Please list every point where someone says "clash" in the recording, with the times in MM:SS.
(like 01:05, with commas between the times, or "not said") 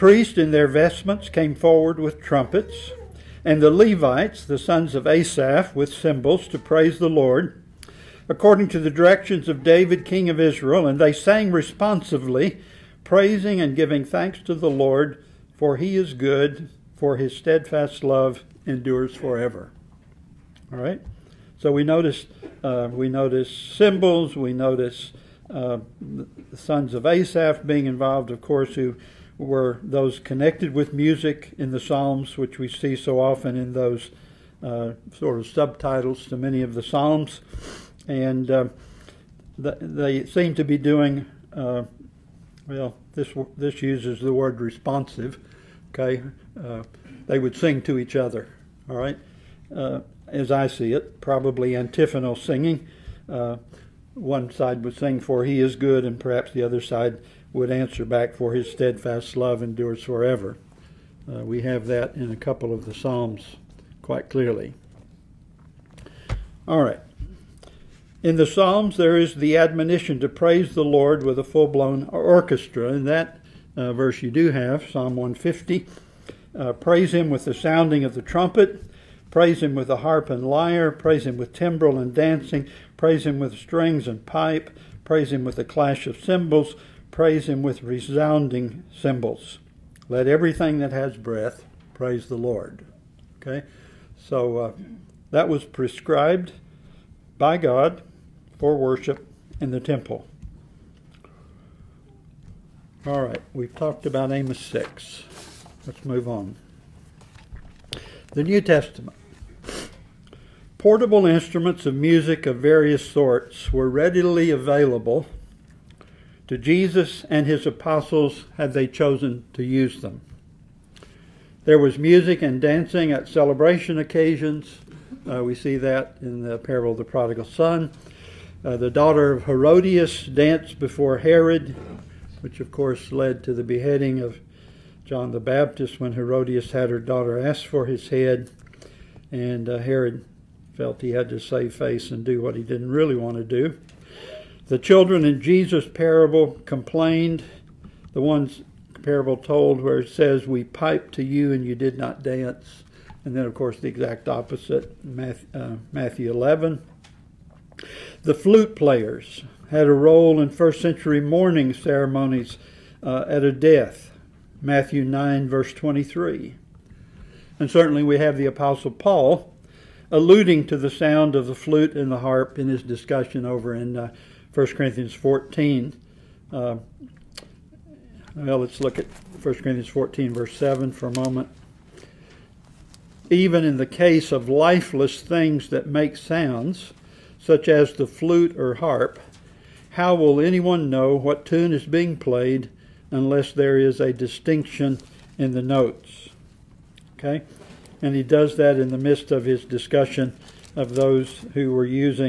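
01:25.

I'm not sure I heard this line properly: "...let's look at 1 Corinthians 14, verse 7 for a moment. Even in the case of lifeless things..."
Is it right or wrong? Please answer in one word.
right.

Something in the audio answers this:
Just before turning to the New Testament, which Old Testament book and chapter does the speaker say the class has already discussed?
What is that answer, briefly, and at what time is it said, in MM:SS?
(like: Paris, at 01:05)
Amos 6, at 01:44.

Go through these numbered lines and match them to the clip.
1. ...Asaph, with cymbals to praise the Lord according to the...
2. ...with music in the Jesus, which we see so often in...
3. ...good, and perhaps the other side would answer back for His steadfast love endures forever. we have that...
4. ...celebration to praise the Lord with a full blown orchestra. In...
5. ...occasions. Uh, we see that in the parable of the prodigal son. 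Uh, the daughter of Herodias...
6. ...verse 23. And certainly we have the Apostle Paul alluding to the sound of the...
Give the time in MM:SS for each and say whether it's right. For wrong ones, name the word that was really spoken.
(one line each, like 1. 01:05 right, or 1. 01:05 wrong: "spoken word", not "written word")
1. 00:05 right
2. 00:30 wrong: "Psalms", not "Jesus"
3. 00:55 right
4. 01:09 wrong: "admonition", not "celebration"
5. 02:03 right
6. 02:45 right.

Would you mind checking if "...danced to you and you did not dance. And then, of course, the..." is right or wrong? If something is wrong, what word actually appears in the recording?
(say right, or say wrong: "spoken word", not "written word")
wrong: "piped", not "danced".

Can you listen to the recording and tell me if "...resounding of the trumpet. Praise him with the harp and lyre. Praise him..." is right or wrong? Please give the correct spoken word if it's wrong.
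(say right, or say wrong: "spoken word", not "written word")
wrong: "sounding", not "resounding".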